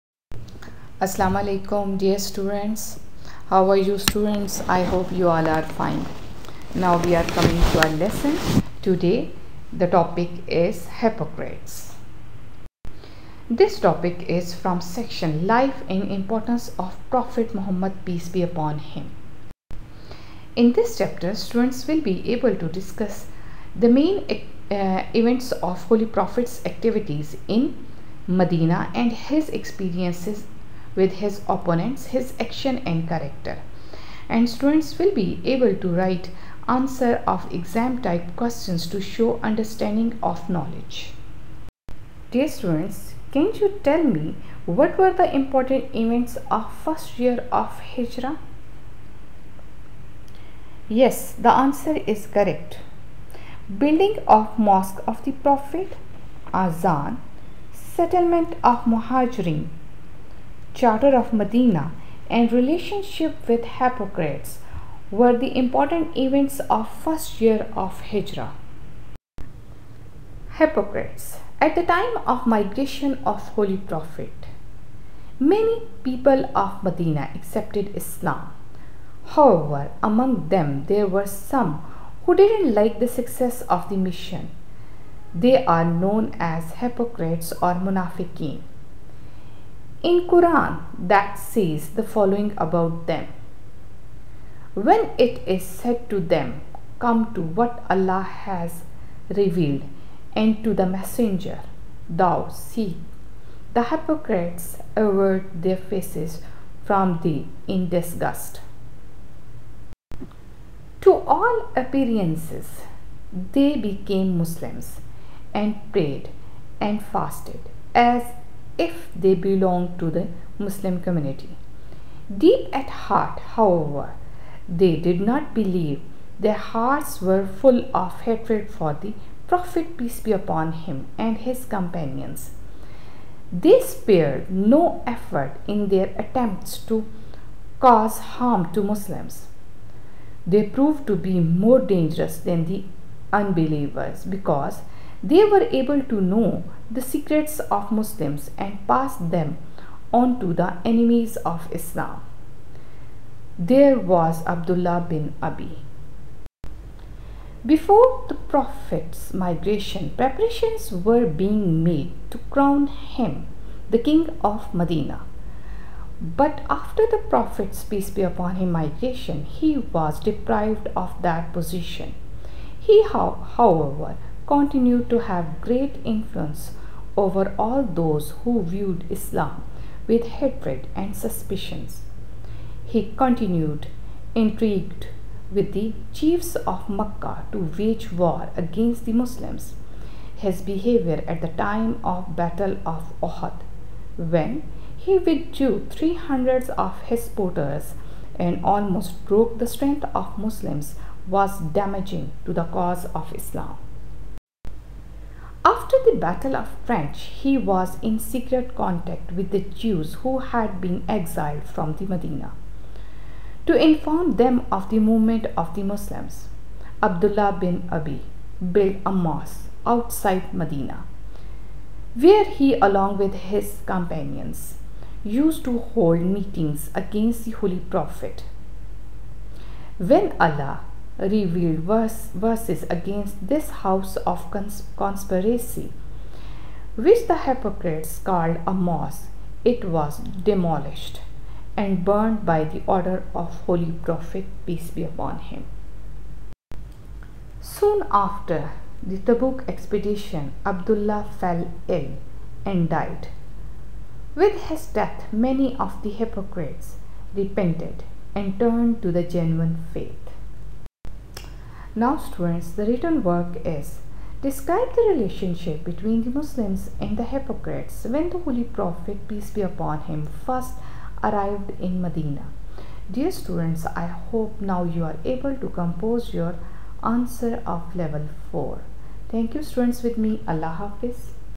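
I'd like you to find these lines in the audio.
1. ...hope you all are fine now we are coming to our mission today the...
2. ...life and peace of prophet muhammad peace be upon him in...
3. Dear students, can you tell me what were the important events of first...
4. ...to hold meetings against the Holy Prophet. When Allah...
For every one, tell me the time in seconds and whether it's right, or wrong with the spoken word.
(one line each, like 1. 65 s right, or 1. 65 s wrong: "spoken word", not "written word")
1. 4 s wrong: "lesson", not "mission"
2. 15 s wrong: "importance", not "peace"
3. 42 s right
4. 225 s right.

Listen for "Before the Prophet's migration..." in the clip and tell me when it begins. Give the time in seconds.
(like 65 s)
157 s.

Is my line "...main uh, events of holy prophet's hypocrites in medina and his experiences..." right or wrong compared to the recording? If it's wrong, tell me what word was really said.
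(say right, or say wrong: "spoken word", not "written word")
wrong: "activities", not "hypocrites".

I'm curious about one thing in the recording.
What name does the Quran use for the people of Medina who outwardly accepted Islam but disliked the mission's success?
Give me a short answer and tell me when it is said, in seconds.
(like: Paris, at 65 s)
munafiqeen, at 87 s.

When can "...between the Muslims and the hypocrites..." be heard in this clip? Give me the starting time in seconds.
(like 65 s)
265 s.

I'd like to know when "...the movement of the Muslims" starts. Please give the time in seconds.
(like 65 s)
214 s.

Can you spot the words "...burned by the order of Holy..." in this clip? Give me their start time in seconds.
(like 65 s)
242 s.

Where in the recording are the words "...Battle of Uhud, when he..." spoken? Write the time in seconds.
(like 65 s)
192 s.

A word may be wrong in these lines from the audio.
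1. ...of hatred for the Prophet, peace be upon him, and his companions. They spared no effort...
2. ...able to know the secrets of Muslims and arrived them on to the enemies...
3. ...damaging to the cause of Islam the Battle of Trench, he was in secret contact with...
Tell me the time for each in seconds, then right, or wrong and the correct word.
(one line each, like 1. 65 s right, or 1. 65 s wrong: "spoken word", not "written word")
1. 128 s right
2. 145 s wrong: "passed", not "arrived"
3. 201 s right.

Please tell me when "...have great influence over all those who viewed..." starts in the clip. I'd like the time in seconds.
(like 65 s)
175 s.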